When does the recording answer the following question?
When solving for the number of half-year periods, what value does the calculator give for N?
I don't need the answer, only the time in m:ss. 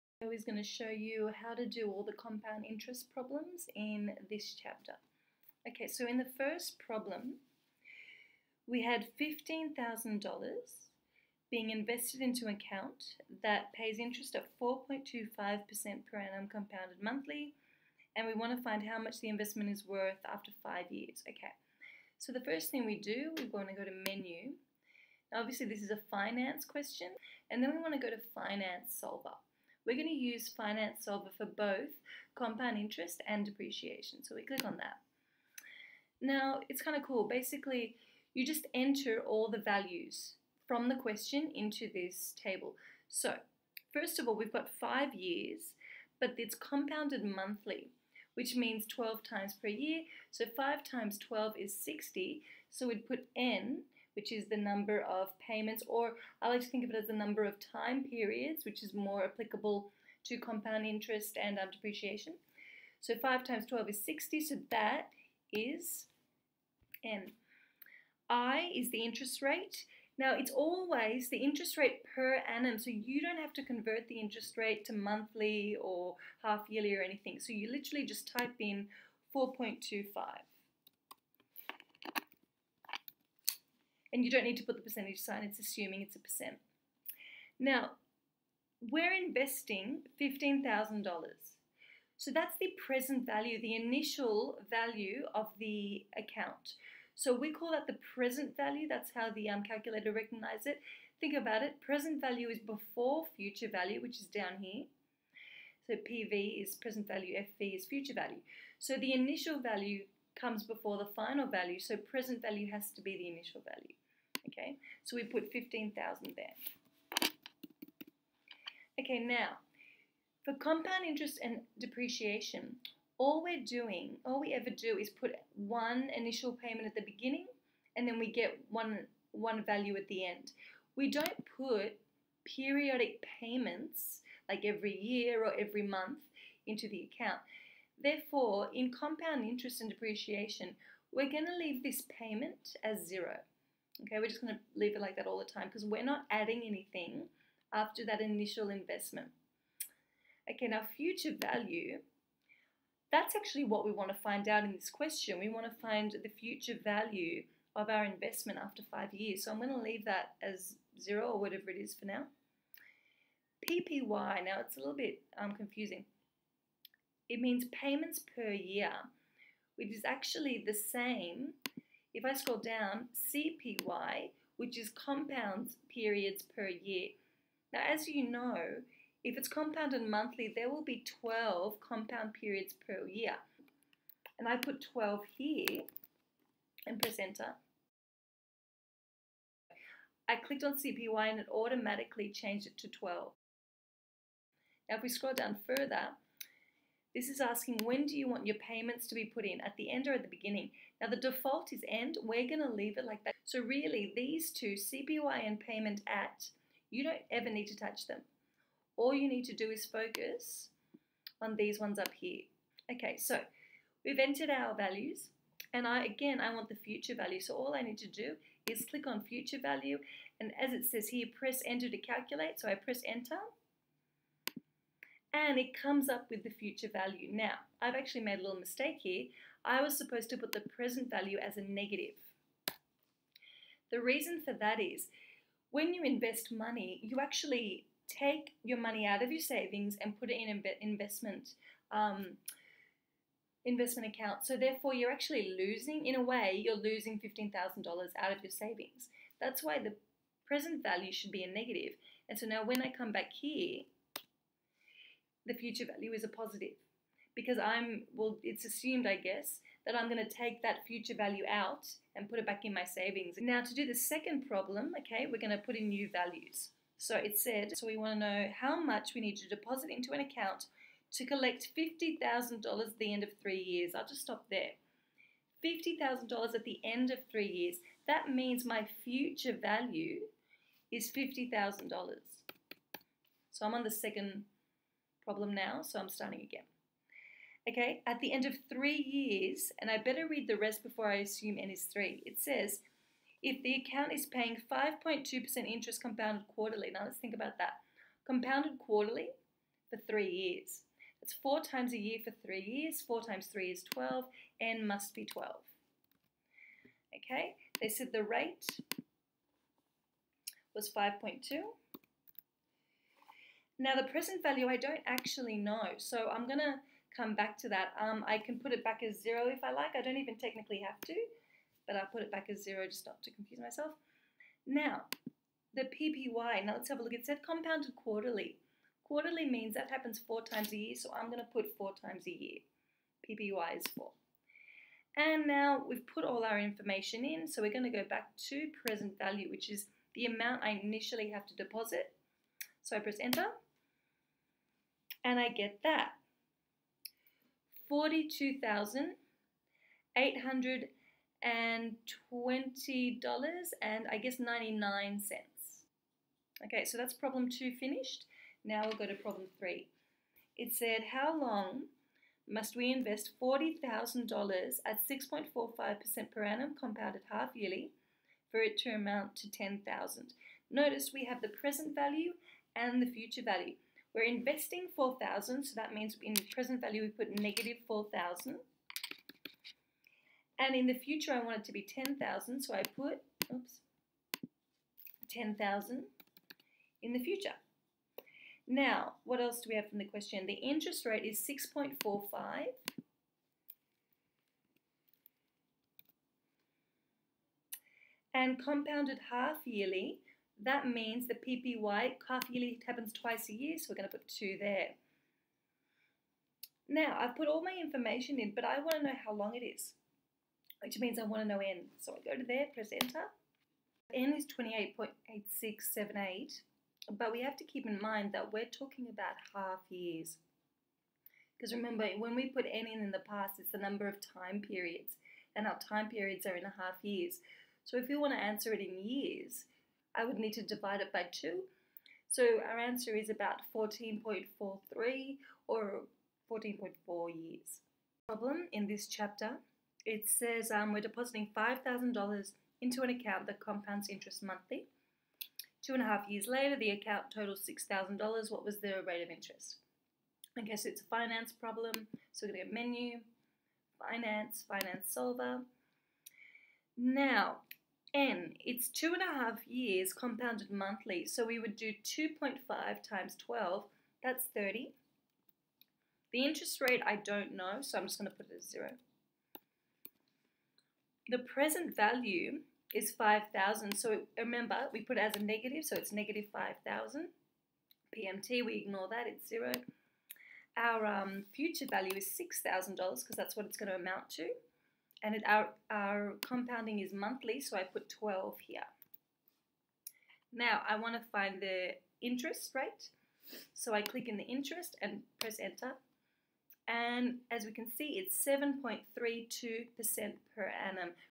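6:54.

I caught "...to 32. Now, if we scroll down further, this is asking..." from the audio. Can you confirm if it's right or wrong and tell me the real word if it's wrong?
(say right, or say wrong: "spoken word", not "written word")
wrong: "12", not "32".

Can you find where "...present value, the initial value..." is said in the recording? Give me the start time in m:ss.
1:32.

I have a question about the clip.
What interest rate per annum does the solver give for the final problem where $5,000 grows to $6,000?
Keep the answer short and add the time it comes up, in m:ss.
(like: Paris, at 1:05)
7.32%, at 8:18.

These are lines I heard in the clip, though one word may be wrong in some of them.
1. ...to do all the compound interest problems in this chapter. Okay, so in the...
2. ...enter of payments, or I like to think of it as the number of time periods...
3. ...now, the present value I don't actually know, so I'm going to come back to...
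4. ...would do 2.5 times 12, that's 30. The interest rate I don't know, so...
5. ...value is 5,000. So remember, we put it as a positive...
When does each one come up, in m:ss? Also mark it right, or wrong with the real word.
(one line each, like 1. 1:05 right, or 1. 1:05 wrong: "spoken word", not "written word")
1. 0:01 right
2. 0:54 wrong: "number", not "enter"
3. 5:13 right
4. 7:41 right
5. 7:51 wrong: "negative", not "positive".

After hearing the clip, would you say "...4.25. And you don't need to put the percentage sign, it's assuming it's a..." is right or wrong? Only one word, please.
right.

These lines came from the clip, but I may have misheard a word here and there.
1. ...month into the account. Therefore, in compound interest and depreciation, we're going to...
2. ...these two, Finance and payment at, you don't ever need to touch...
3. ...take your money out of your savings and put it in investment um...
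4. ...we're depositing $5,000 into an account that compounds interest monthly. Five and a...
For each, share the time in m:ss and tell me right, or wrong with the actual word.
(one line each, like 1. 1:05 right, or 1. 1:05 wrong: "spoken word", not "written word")
1. 2:15 right
2. 3:24 wrong: "CPY", not "Finance"
3. 3:58 right
4. 7:20 wrong: "Two", not "Five".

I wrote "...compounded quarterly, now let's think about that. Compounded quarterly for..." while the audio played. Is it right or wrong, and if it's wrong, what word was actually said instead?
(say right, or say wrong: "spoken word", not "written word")
right.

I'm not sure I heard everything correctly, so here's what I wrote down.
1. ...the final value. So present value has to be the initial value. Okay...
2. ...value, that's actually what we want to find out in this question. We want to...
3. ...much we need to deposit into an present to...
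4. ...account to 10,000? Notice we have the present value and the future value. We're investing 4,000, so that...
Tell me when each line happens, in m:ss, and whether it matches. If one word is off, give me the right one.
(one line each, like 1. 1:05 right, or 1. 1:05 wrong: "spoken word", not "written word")
1. 1:50 right
2. 2:31 right
3. 4:28 wrong: "account", not "present"
4. 6:08 wrong: "amount", not "account".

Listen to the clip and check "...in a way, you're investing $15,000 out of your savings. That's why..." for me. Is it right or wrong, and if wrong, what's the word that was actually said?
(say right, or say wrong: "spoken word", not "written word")
wrong: "losing", not "investing".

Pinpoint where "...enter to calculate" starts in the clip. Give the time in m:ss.
3:41.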